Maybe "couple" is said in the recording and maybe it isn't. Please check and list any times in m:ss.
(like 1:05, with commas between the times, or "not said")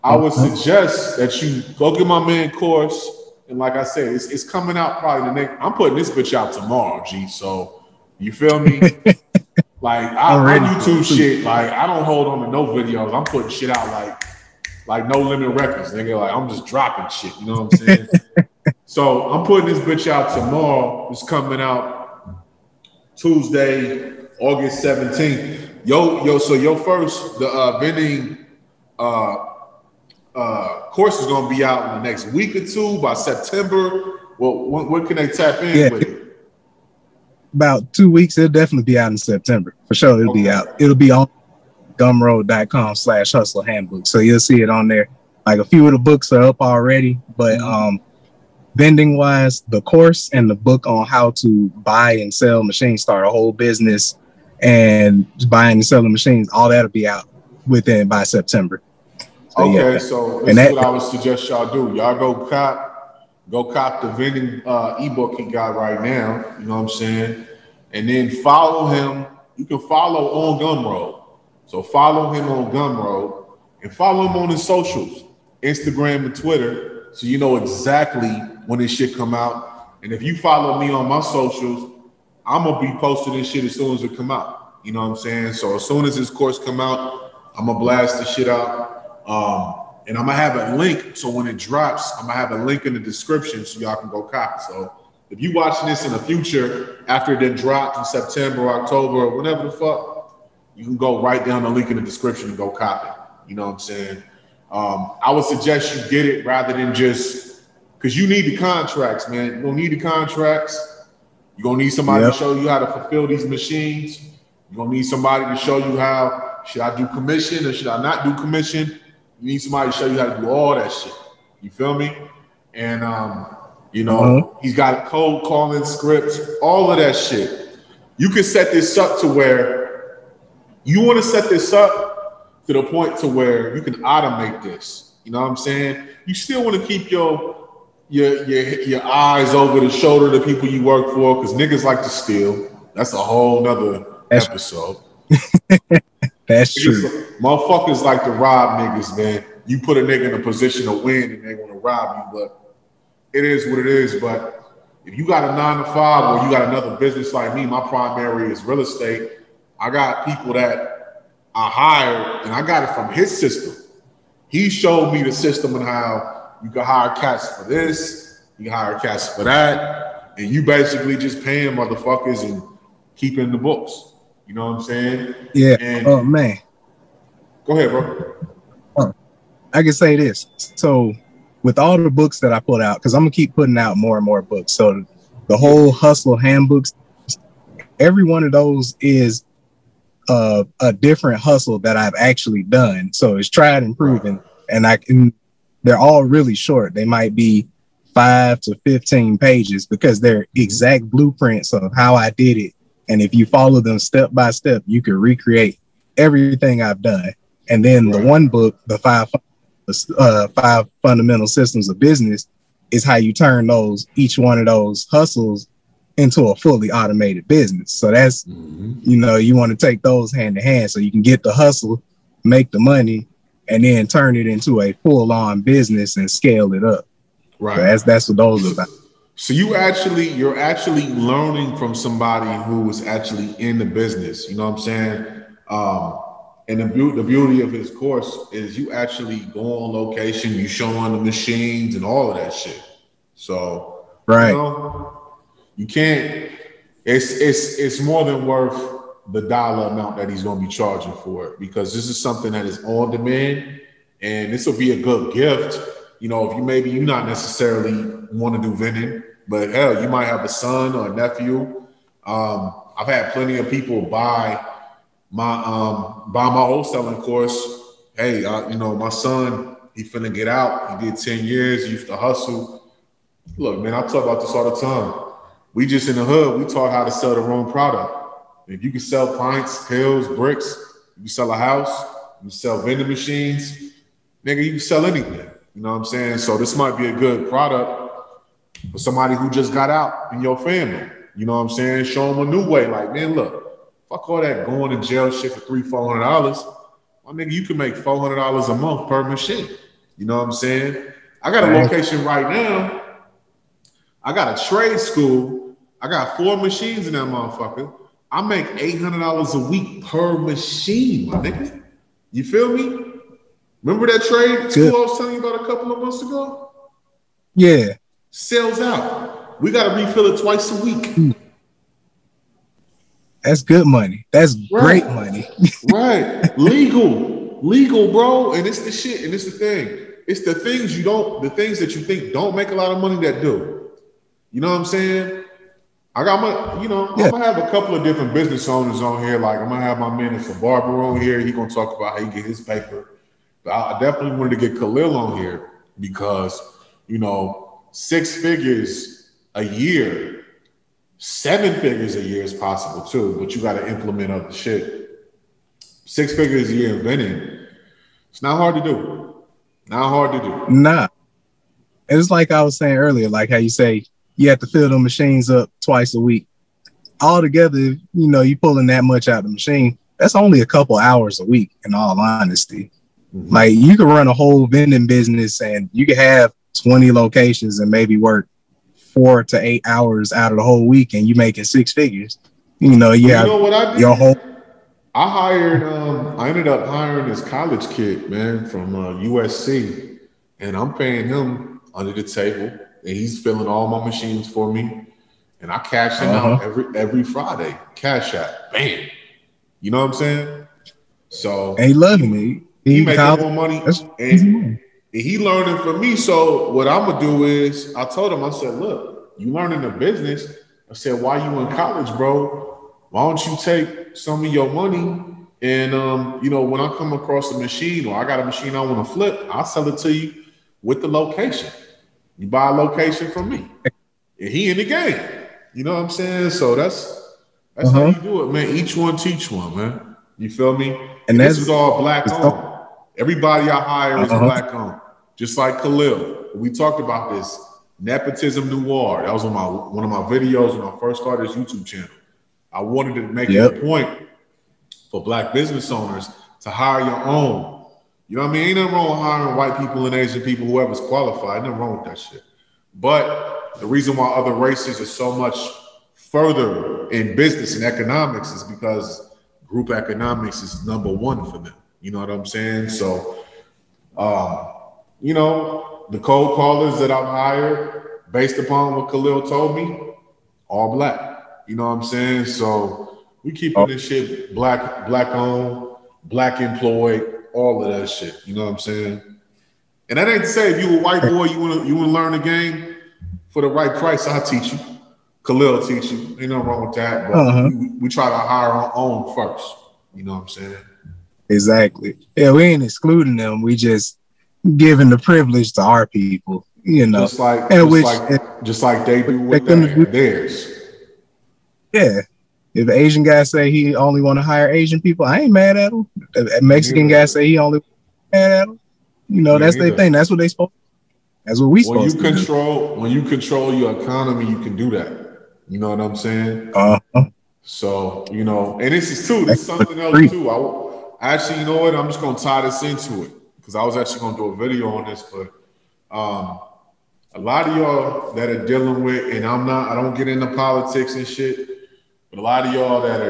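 5:15, 5:37, 6:10.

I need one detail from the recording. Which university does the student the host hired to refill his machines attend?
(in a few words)
USC.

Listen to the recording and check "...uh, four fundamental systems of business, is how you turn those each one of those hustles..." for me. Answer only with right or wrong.
wrong.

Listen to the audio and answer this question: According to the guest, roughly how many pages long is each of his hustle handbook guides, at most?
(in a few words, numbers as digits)
15.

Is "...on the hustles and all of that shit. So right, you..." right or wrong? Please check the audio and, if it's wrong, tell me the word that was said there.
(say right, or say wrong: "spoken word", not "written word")
wrong: "machines", not "hustles".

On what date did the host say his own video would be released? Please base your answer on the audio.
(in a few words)
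Tuesday, August 17th.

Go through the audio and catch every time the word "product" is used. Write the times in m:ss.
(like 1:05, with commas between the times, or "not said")
4:37, 4:47.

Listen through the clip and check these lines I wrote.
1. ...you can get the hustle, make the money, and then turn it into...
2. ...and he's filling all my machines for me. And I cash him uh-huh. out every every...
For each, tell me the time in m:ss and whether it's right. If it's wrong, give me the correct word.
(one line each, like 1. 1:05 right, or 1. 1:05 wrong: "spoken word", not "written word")
1. 3:40 right
2. 6:32 right.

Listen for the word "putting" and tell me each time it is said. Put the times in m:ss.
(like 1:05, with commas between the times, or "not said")
0:05, 0:13, 0:19, 3:03.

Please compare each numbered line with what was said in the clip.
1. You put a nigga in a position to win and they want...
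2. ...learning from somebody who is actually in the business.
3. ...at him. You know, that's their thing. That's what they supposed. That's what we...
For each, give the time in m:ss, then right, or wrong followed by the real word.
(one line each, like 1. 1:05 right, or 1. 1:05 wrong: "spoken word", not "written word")
1. 2:29 right
2. 3:51 right
3. 8:28 right.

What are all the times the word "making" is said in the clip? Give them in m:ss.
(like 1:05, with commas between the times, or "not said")
6:21, 6:43.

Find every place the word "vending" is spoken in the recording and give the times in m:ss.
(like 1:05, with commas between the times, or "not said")
0:27, 0:48, 1:04, 4:18, 4:42, 5:57, 6:14.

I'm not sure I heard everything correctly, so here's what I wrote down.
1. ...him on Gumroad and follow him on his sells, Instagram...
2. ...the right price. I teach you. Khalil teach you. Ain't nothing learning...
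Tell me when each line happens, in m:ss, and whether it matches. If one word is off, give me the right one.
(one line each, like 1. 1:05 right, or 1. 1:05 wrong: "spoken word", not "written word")
1. 1:12 wrong: "socials", not "sells"
2. 8:03 wrong: "wrong", not "learning".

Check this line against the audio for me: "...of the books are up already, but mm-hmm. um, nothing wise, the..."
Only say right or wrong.
wrong.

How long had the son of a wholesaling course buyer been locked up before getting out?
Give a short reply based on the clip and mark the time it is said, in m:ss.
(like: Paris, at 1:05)
ten years, at 4:31.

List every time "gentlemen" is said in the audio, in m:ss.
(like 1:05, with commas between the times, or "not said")
not said.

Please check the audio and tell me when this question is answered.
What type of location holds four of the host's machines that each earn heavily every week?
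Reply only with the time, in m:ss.
5:04.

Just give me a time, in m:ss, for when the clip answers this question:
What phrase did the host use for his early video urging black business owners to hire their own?
7:17.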